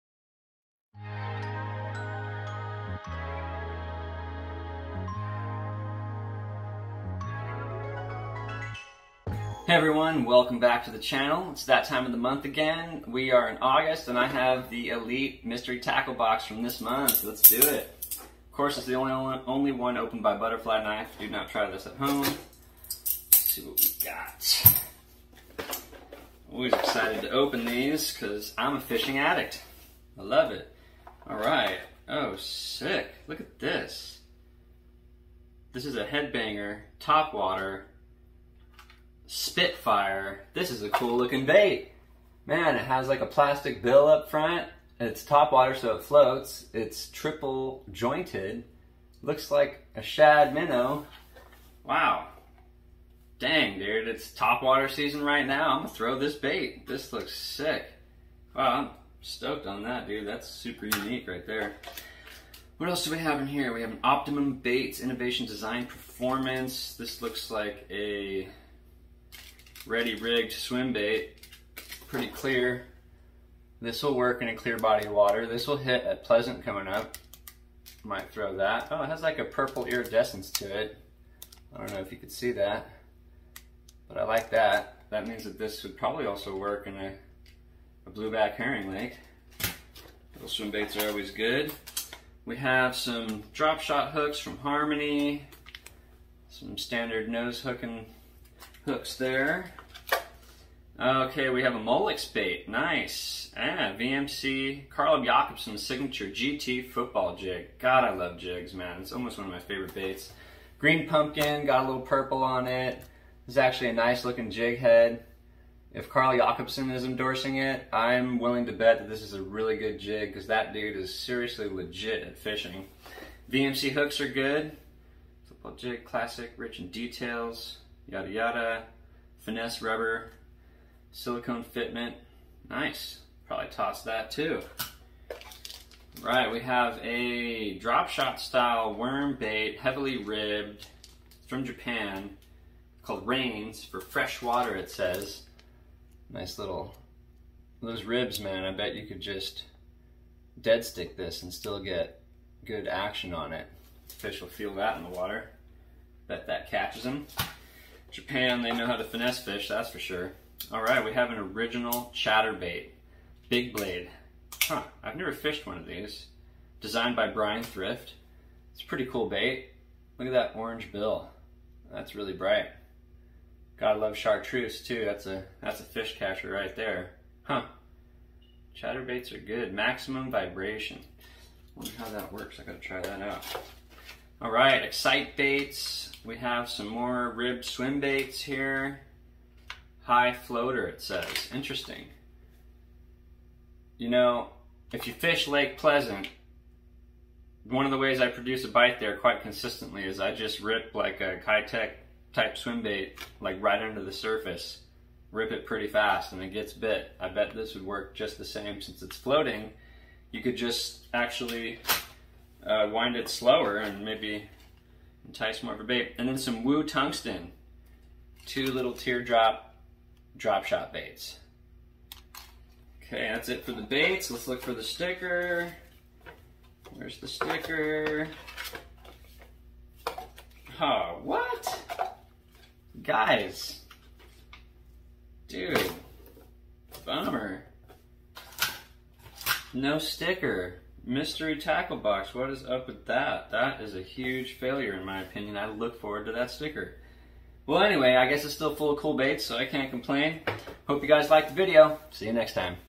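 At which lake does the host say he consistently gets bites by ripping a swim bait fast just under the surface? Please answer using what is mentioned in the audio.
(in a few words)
Lake Pleasant.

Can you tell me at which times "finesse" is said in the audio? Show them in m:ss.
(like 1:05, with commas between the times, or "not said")
2:09, 2:39.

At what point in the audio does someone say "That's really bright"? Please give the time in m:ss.
2:51.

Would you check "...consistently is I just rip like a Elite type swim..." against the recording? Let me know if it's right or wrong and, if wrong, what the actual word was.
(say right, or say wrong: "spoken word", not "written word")
wrong: "Keitech", not "Elite".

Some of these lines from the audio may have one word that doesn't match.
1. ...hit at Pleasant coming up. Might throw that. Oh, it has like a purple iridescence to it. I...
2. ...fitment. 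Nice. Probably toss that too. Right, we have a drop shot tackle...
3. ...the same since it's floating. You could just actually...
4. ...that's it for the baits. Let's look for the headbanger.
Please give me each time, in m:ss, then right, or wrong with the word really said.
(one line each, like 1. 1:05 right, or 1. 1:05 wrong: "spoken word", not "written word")
1. 1:15 right
2. 2:11 wrong: "style", not "tackle"
3. 3:28 right
4. 3:43 wrong: "sticker", not "headbanger".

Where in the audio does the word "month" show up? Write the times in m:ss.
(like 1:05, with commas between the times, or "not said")
0:12, 0:16.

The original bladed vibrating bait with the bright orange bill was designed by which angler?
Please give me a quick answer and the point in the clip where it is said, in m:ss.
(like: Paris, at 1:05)
Bryan Thrift, at 2:47.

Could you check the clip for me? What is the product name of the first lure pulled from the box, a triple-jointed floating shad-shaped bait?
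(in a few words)
Headbanger.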